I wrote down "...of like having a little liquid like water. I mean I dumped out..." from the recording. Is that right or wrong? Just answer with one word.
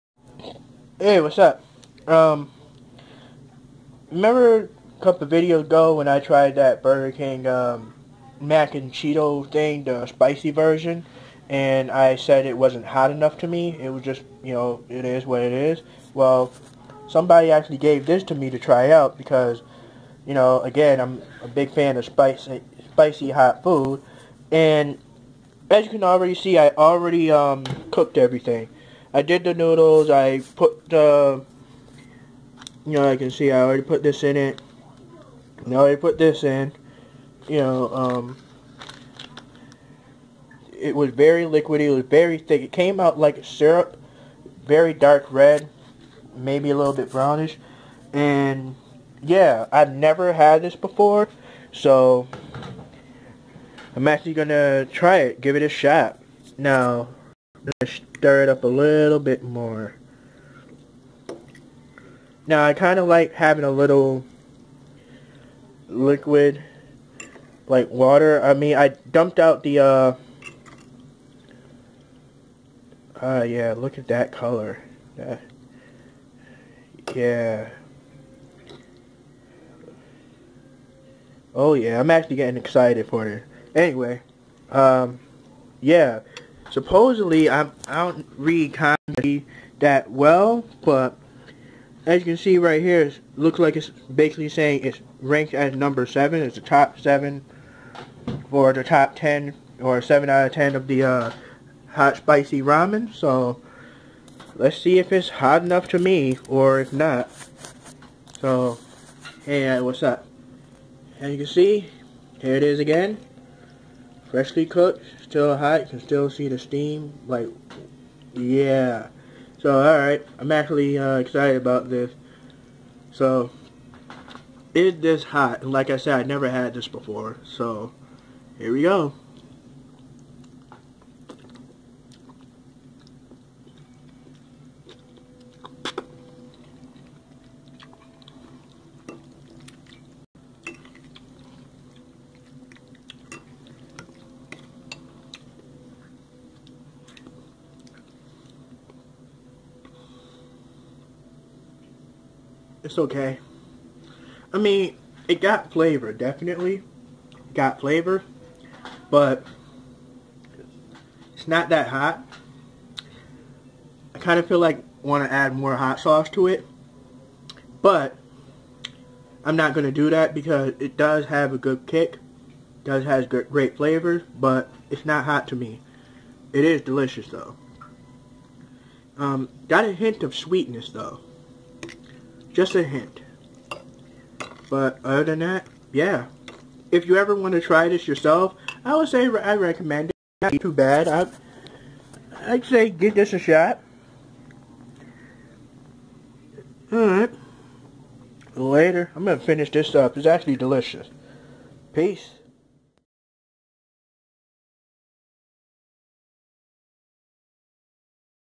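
right.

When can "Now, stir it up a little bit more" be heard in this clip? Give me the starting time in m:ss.
0:56.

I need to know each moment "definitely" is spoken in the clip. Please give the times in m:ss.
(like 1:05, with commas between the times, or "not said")
2:36.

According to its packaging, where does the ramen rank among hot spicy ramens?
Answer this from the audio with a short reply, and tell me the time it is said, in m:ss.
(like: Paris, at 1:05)
7, at 1:35.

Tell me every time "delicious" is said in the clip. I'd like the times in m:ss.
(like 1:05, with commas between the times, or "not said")
2:56, 3:20.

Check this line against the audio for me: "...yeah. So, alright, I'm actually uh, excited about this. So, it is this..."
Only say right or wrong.
right.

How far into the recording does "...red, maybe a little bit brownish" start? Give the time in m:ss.
0:45.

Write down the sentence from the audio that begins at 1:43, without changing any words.
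So let's see if it's hot enough to me or if not.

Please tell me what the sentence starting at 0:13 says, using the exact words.
It was just, you know, it is what it is.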